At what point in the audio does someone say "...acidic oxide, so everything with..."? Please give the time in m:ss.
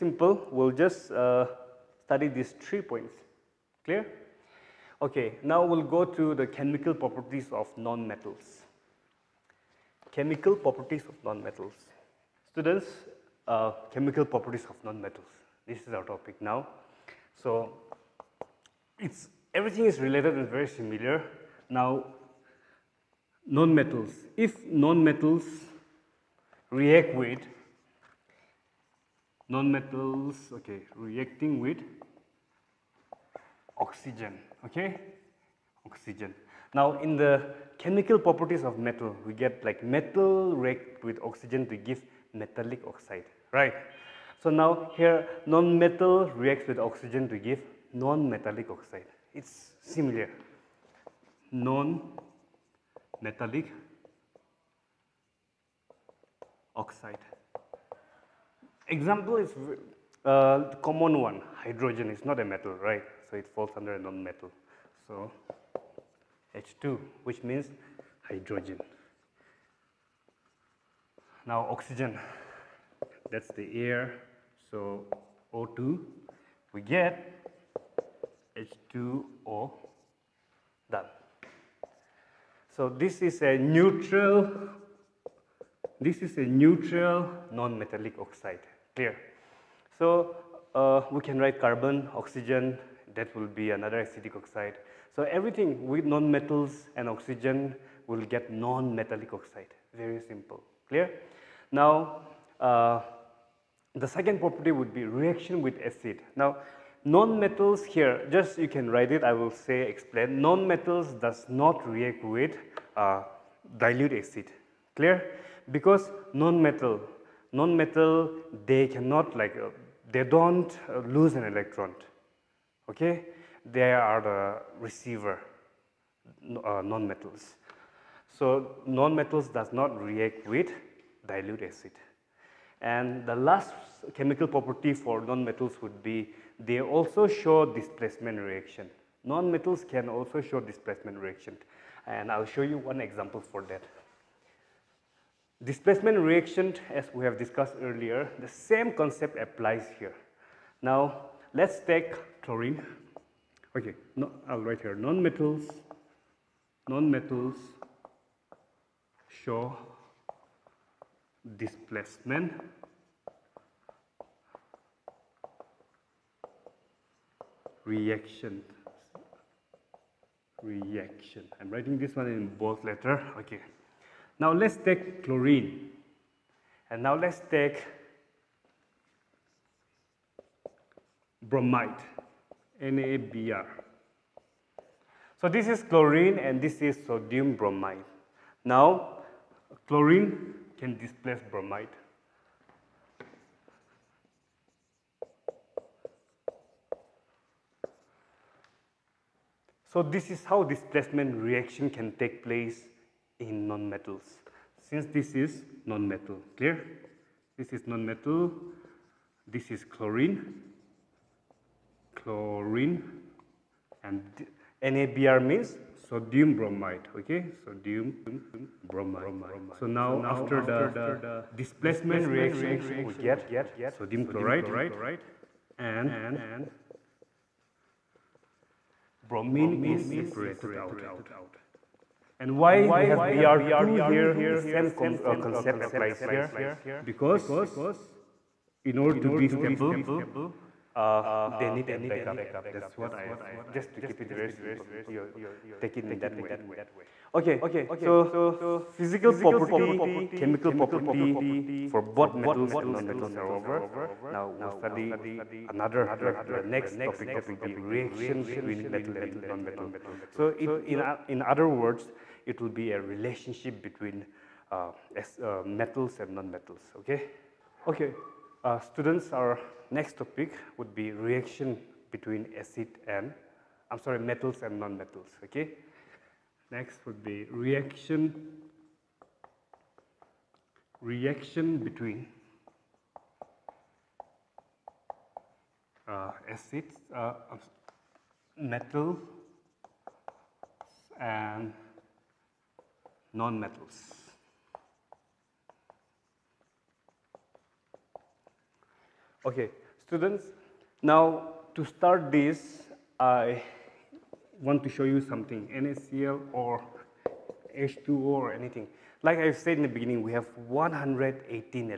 1:34.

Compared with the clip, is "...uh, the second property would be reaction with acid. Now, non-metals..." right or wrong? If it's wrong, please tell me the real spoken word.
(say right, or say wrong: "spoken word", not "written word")
right.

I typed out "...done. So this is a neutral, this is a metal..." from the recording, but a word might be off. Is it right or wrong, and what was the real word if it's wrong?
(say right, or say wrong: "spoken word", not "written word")
wrong: "neutral", not "metal".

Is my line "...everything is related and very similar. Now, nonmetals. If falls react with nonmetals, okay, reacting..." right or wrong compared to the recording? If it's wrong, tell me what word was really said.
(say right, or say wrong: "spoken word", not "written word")
wrong: "nonmetals", not "falls".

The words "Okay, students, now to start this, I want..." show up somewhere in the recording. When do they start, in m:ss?
4:59.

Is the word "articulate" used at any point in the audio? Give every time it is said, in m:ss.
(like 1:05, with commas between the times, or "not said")
not said.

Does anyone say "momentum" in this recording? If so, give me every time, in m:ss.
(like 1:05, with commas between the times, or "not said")
not said.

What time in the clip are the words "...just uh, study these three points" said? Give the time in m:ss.
0:00.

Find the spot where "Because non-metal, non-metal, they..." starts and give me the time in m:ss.
1:55.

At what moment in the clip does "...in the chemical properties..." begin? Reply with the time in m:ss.
0:37.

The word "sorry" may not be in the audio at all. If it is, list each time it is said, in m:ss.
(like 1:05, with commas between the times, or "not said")
4:34.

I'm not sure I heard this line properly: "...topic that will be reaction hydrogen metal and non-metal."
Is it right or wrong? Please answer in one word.
wrong.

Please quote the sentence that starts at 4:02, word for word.
That's what I, just to keep it very simple, you take it in that way.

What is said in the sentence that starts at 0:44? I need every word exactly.
So now here non-metal reacts with oxygen to give non-metallic oxide.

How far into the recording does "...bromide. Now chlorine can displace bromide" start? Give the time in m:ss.
3:07.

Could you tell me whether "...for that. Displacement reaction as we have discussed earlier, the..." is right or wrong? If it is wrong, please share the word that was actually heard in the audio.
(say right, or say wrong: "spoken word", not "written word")
right.